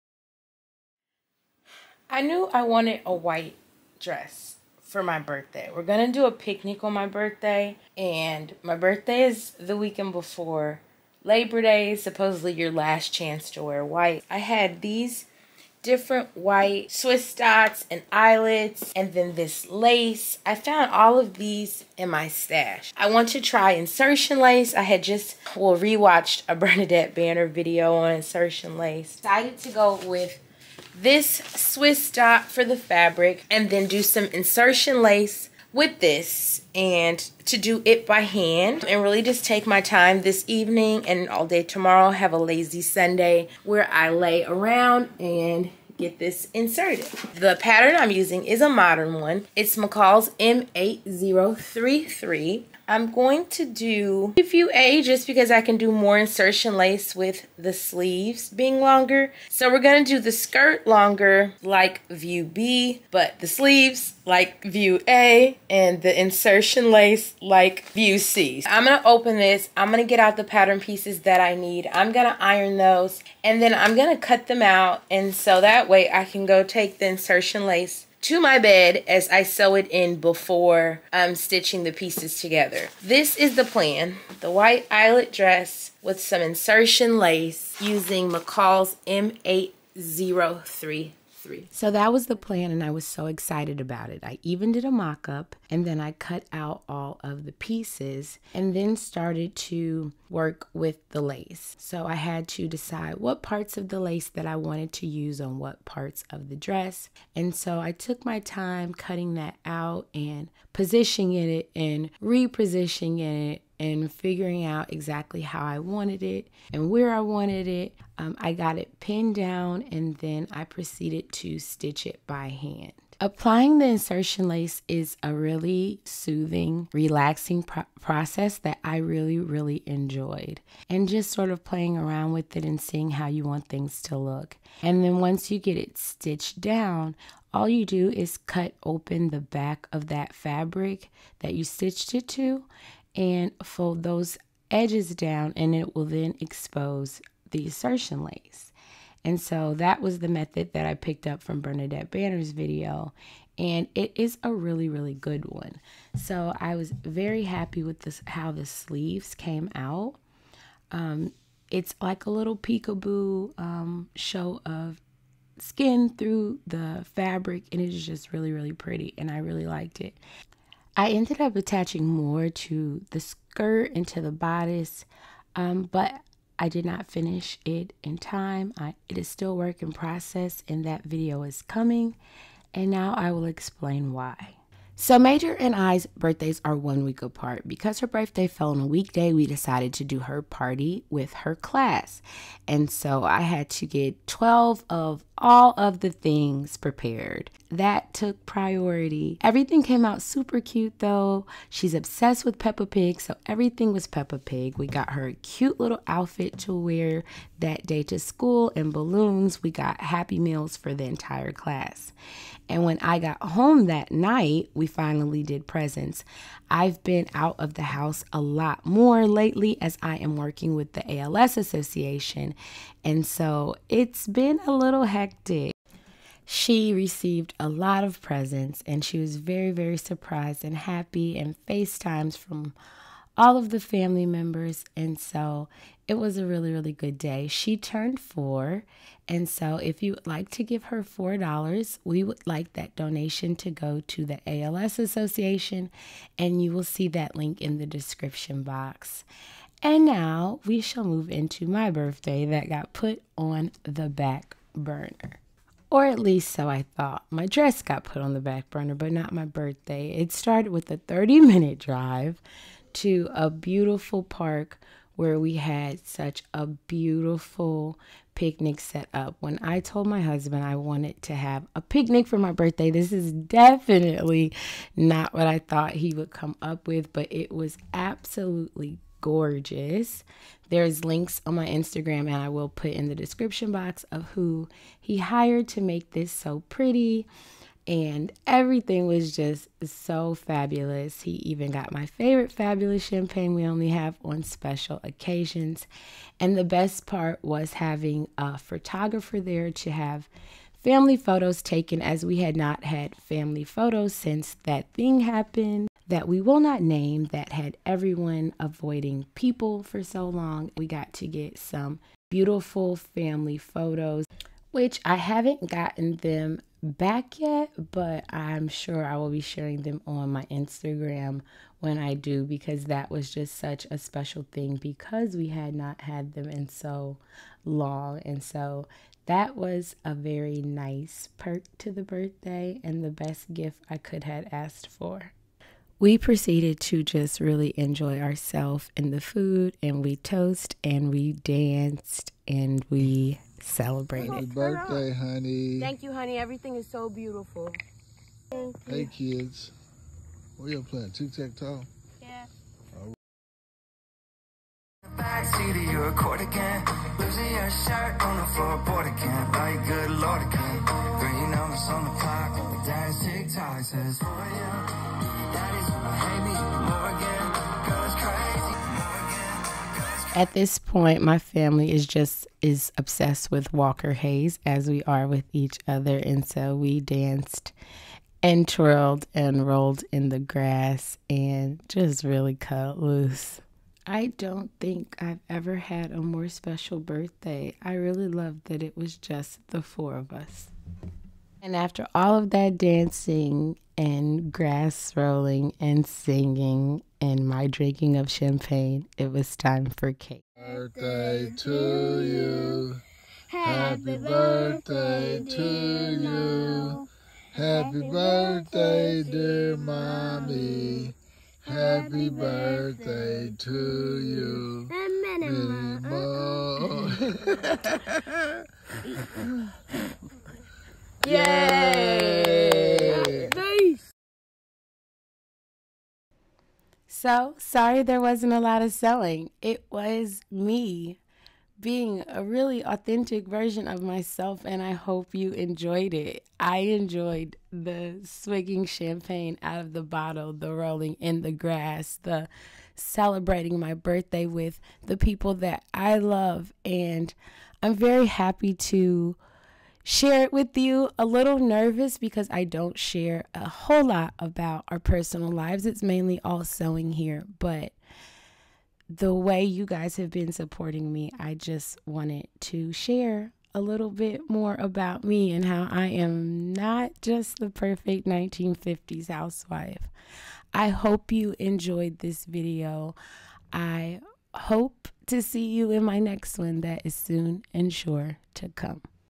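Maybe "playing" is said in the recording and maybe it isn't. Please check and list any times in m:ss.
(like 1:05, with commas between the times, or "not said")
2:11, 5:50.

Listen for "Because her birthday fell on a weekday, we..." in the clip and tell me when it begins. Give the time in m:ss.
3:07.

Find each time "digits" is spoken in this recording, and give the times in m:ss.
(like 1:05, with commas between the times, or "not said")
not said.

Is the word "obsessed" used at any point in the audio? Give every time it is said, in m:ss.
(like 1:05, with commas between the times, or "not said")
3:21, 6:12.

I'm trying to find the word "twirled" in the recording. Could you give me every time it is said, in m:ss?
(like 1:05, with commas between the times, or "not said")
6:18.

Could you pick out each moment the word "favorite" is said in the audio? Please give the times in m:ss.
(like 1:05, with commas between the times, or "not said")
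4:52.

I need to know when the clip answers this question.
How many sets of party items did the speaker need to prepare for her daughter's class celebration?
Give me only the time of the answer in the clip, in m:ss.
3:14.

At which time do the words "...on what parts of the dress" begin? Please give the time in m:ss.
1:45.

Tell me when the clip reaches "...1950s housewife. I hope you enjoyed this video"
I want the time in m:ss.
7:48.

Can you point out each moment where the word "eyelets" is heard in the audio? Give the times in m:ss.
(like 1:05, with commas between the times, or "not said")
0:18, 1:24.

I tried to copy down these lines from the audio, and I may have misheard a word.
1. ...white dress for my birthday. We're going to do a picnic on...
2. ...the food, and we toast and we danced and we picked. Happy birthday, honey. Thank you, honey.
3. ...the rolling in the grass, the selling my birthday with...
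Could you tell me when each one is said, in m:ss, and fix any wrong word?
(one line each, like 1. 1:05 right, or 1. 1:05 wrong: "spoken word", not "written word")
1. 0:03 right
2. 5:39 wrong: "celebrated", not "picked"
3. 7:20 wrong: "celebrating", not "selling".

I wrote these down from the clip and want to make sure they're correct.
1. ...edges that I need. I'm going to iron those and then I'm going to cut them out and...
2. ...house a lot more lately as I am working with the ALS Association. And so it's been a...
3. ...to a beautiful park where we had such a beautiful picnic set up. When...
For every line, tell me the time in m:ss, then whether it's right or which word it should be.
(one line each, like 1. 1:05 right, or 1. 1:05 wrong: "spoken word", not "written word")
1. 1:10 wrong: "pieces", not "edges"
2. 3:37 right
3. 4:22 right.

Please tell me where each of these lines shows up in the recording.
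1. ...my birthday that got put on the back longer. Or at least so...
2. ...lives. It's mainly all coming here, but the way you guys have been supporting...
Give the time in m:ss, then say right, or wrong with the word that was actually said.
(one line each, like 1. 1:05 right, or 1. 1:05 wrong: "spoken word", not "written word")
1. 4:11 wrong: "burner", not "longer"
2. 7:35 wrong: "sewing", not "coming".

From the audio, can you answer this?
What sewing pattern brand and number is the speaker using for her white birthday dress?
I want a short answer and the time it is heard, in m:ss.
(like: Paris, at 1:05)
McCall's M8033, at 0:49.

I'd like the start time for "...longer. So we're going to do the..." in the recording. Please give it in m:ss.
0:58.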